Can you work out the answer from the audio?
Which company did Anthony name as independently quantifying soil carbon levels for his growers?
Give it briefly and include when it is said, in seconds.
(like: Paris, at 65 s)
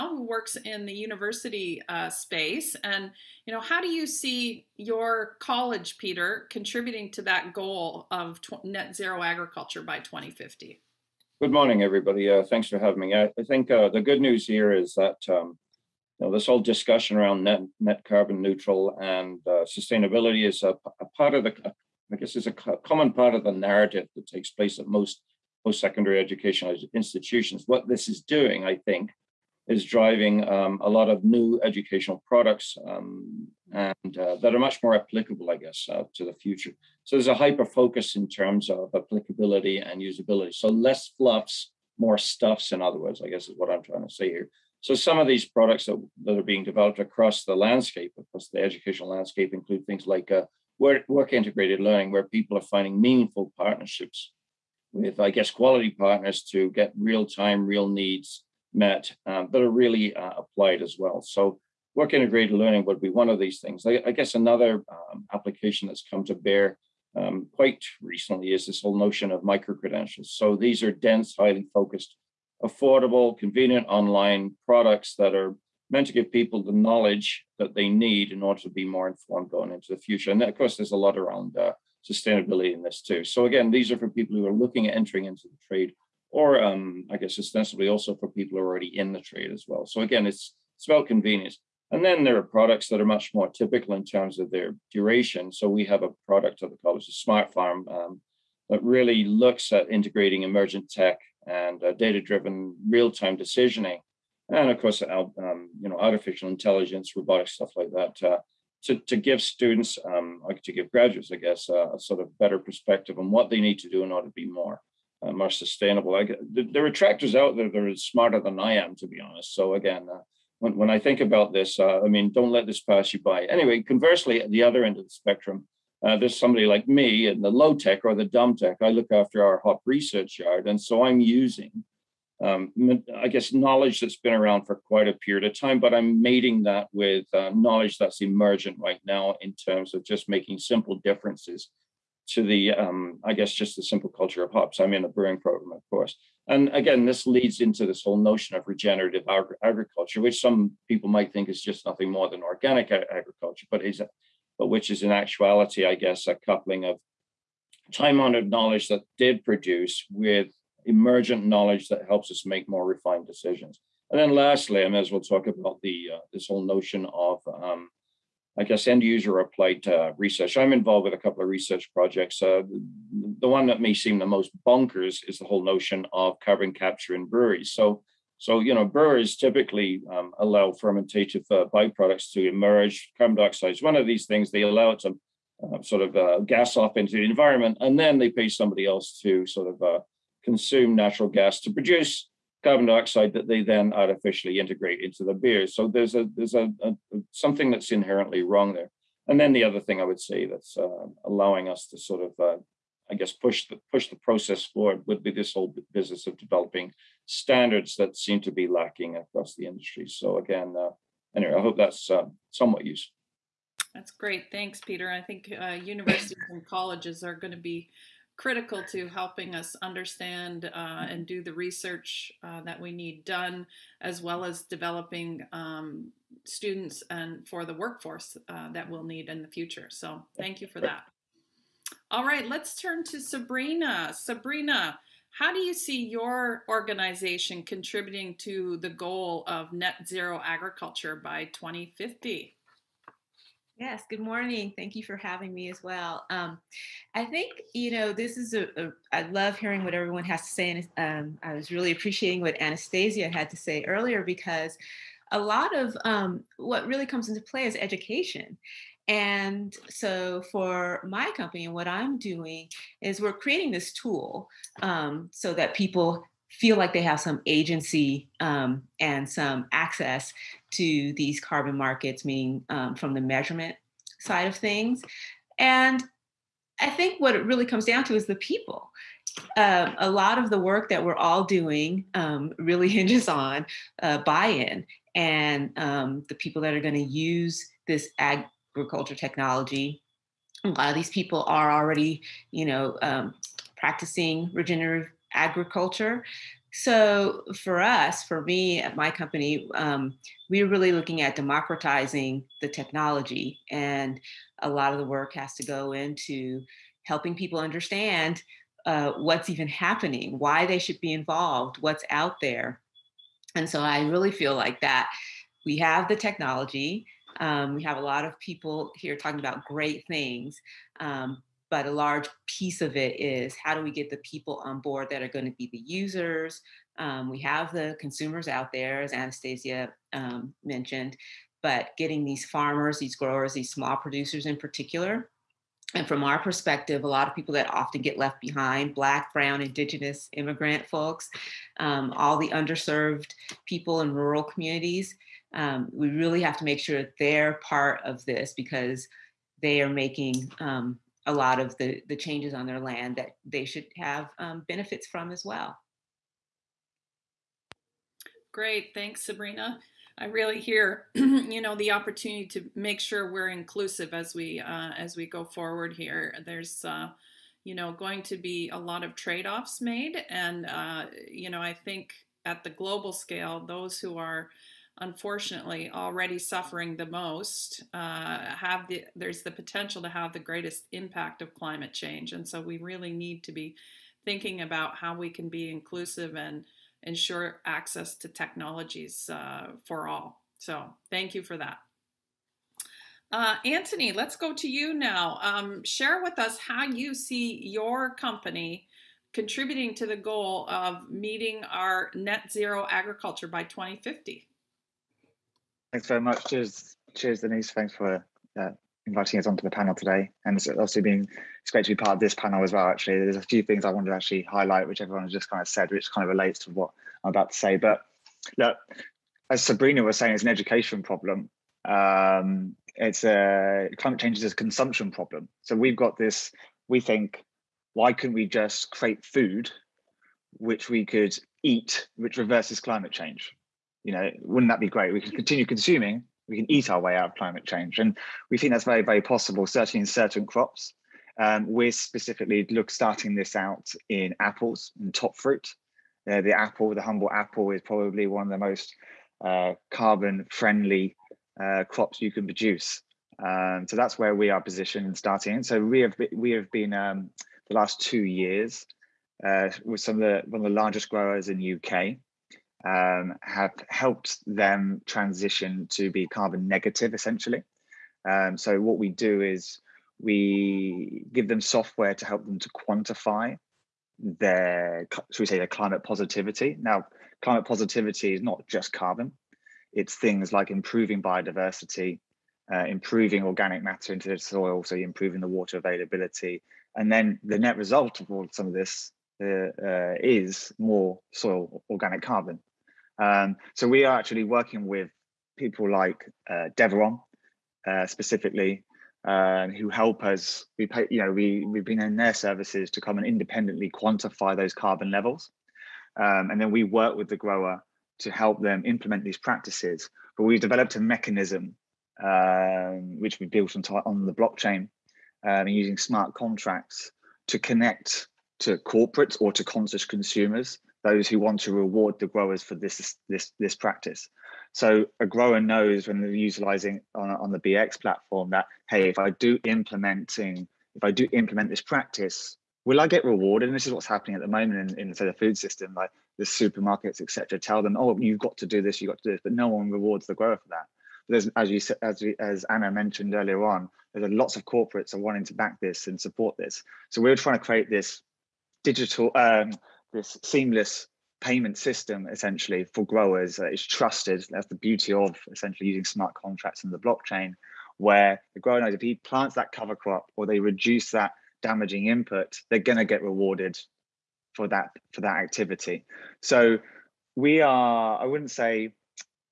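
Deveron, at 496 s.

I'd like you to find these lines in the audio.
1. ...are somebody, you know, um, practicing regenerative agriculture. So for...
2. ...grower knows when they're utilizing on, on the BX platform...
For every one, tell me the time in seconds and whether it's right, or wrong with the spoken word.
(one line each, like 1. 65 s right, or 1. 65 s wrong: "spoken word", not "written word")
1. 291 s wrong: "already", not "somebody"
2. 525 s right.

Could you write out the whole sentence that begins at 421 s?
Um, it's a climate change is a consumption problem.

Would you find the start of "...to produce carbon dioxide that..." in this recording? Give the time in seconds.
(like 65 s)
191 s.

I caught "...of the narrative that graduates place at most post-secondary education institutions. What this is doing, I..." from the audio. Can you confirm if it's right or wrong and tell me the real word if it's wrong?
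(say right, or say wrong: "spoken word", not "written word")
wrong: "takes", not "graduates".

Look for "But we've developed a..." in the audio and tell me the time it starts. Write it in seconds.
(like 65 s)
510 s.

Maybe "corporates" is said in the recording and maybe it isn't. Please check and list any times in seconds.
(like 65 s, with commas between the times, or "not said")
518 s, 544 s.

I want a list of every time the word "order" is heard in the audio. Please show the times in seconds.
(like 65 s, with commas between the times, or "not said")
78 s, 114 s.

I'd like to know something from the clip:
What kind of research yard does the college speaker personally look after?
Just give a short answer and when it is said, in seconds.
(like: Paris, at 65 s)
Hop research yard, at 129 s.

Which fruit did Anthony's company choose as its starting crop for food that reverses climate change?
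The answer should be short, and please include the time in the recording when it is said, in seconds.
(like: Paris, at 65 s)
Apples, at 444 s.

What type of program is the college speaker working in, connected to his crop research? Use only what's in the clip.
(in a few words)
Brewing program.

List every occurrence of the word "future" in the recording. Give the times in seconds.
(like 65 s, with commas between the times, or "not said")
36 s, 79 s, 229 s.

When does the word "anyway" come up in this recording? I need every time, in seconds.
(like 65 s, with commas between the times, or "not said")
123 s, 211 s.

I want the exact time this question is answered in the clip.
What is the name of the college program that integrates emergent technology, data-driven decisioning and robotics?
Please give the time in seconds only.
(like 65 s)
97 s.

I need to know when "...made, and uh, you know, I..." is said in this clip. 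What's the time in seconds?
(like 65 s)
369 s.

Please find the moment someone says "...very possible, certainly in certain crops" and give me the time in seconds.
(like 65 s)
439 s.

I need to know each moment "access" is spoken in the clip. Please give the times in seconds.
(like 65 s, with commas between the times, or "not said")
269 s, 387 s.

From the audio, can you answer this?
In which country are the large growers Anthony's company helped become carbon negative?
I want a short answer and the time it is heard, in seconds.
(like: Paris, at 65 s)
UK, at 461 s.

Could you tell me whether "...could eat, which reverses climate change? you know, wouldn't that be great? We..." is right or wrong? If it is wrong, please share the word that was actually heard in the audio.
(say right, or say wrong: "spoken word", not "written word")
right.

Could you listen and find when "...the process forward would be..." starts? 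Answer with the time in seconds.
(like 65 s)
204 s.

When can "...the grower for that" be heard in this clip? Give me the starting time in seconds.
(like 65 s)
540 s.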